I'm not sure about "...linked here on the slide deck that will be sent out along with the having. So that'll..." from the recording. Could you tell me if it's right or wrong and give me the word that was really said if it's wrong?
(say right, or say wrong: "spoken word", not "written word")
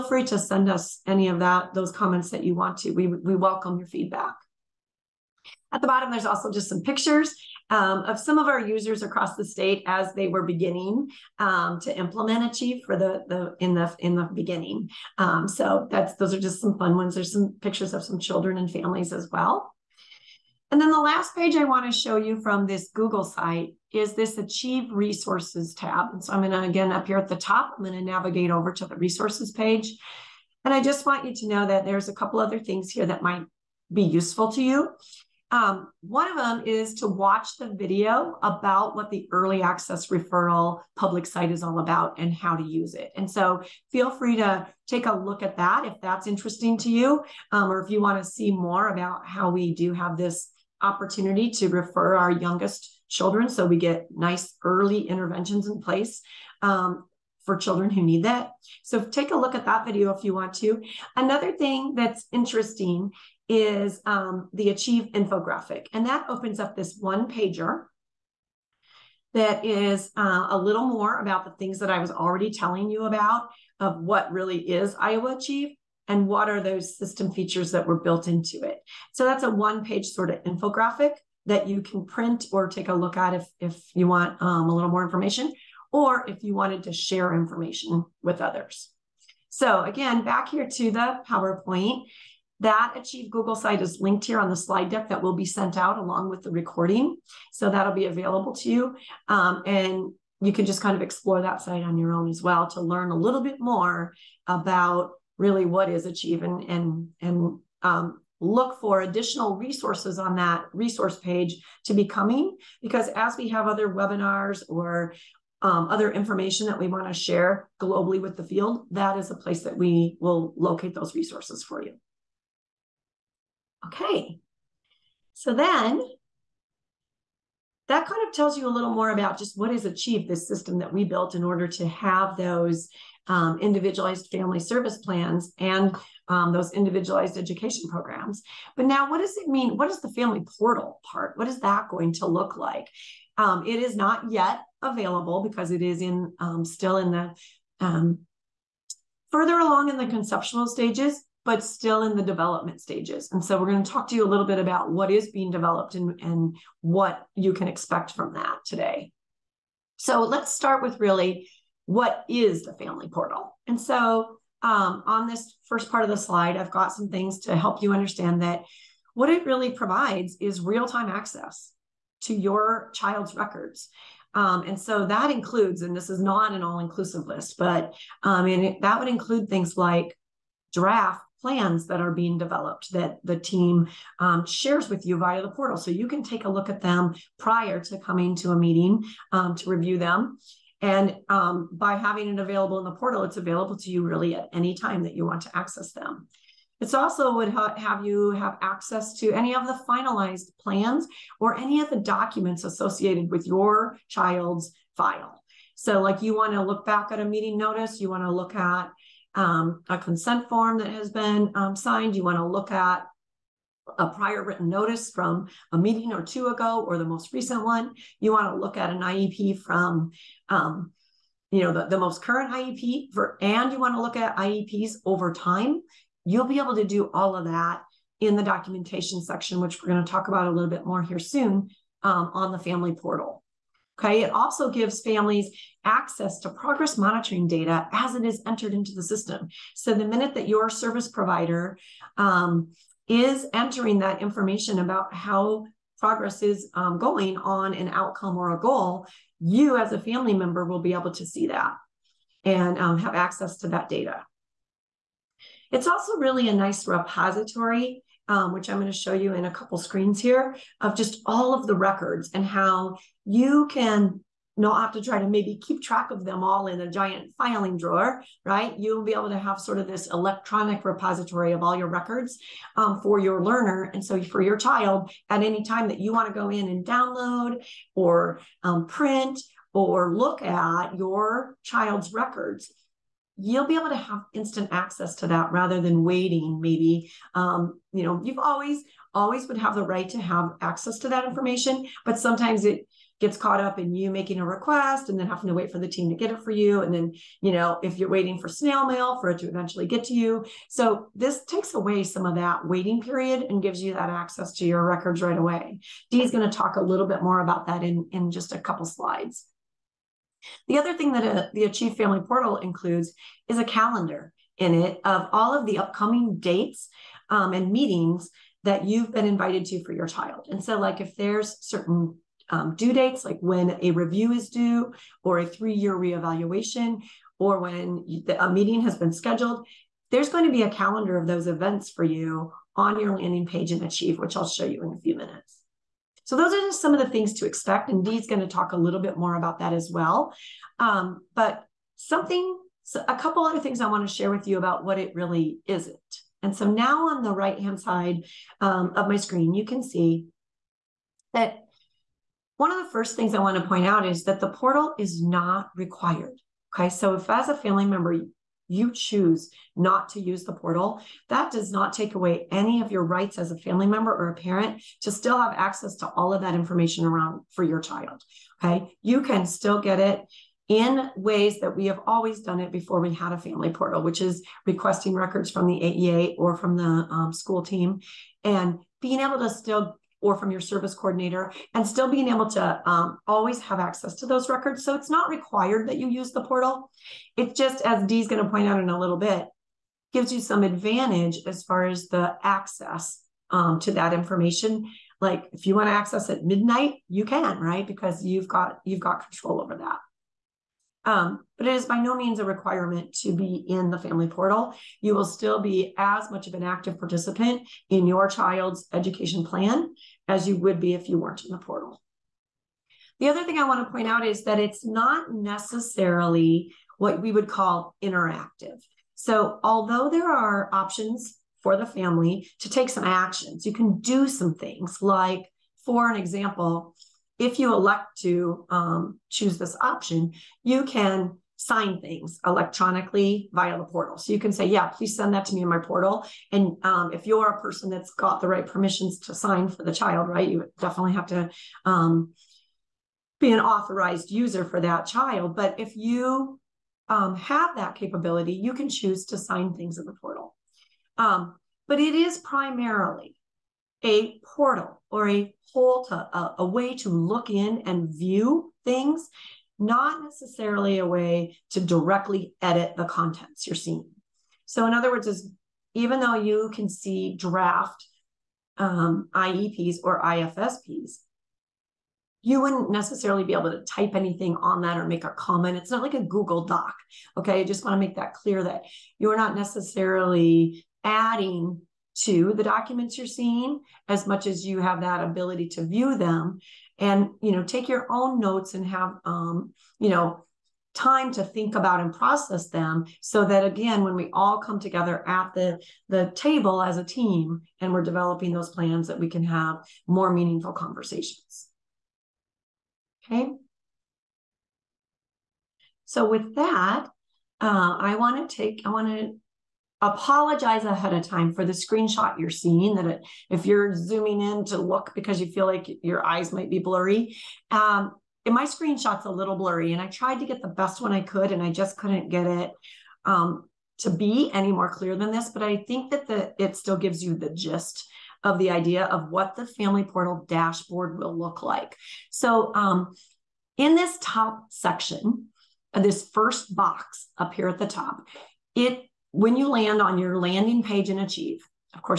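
wrong: "recording", not "having".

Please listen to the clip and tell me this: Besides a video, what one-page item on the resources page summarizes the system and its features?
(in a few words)
Achieve infographic.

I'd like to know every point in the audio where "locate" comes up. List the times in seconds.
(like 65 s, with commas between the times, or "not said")
120 s.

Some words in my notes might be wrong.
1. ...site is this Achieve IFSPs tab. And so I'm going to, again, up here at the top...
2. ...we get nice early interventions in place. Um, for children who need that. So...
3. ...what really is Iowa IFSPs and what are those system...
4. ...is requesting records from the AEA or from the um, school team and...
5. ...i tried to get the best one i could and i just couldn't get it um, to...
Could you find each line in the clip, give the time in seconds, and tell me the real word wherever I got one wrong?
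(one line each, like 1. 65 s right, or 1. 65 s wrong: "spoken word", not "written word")
1. 23 s wrong: "Resources", not "IFSPs"
2. 53 s right
3. 74 s wrong: "Achieve", not "IFSPs"
4. 374 s right
5. 519 s right.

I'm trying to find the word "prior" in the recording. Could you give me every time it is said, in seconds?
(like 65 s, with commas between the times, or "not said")
187 s, 214 s.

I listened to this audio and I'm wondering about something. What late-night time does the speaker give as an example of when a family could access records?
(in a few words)
midnight.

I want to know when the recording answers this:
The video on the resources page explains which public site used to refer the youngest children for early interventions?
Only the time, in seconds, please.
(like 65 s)
39 s.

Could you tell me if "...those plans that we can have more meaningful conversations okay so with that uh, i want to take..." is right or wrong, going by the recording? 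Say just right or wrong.
right.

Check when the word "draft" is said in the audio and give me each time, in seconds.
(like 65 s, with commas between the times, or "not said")
180 s, 467 s.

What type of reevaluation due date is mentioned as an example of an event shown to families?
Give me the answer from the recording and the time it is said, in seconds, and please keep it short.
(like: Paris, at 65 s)
three year reevaluation, at 325 s.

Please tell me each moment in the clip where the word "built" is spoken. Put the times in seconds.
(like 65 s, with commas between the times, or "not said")
77 s, 131 s.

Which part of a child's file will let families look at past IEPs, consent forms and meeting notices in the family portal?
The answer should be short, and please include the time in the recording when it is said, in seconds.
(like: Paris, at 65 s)
documentation section, at 228 s.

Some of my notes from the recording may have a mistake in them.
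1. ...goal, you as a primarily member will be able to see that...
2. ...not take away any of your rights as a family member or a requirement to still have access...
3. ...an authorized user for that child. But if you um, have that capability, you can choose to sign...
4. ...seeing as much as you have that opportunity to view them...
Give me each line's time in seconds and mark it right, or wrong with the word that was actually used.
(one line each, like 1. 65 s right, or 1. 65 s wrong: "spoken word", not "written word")
1. 248 s wrong: "family", not "primarily"
2. 361 s wrong: "parent", not "requirement"
3. 443 s right
4. 483 s wrong: "ability", not "opportunity".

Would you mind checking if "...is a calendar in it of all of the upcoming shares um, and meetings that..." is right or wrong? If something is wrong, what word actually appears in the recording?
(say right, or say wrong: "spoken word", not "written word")
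wrong: "dates", not "shares".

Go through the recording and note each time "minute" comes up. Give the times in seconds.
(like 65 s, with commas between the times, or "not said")
240 s, 335 s.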